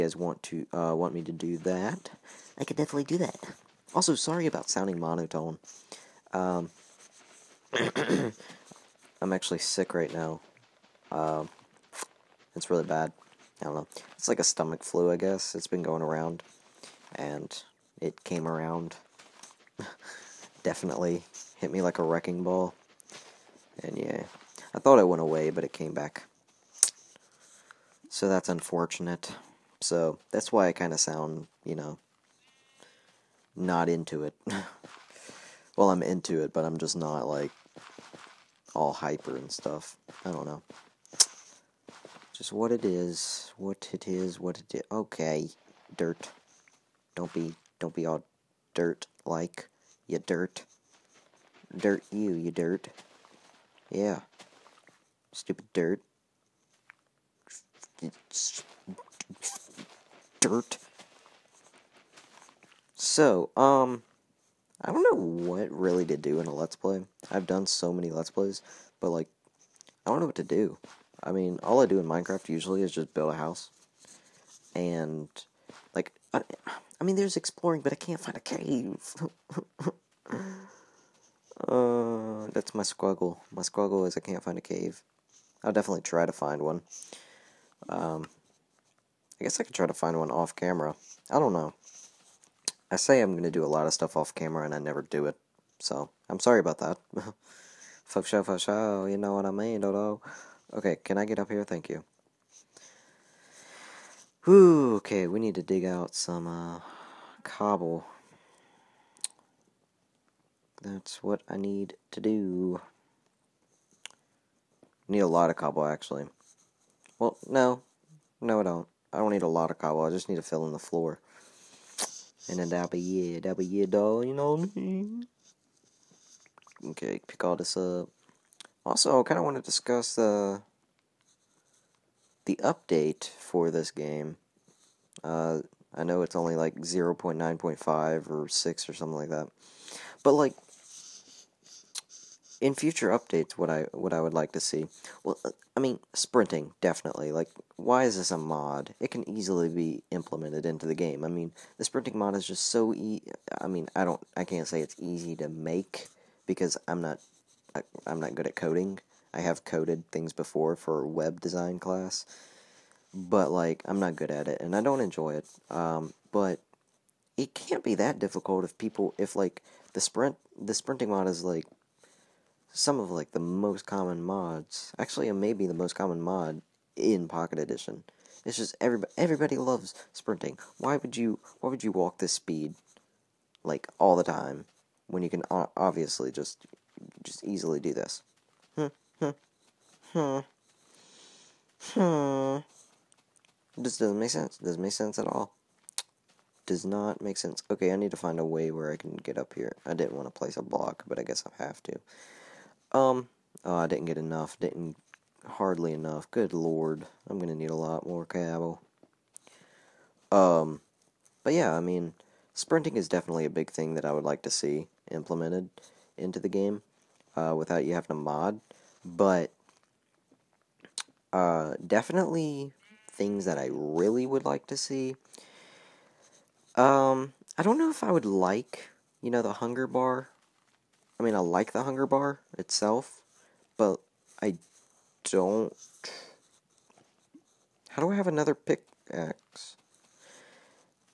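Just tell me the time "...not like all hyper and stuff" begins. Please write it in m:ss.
0:36.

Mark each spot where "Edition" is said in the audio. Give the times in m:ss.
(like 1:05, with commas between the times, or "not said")
2:57.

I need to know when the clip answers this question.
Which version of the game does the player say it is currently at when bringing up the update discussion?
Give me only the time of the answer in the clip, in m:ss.
2:16.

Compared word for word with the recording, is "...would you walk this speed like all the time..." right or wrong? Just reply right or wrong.
right.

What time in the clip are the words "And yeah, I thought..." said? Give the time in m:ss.
0:23.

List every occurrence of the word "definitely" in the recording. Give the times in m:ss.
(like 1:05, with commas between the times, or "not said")
0:02, 0:20, 1:25, 2:26, 3:33, 3:41.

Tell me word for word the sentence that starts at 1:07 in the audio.
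I've done so many Let's Plays, but like, I don't know what to do.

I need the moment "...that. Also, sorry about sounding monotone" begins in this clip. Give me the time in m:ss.
0:03.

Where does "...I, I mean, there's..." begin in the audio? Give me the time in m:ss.
1:16.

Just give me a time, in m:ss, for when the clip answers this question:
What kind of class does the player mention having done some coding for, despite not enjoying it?
2:41.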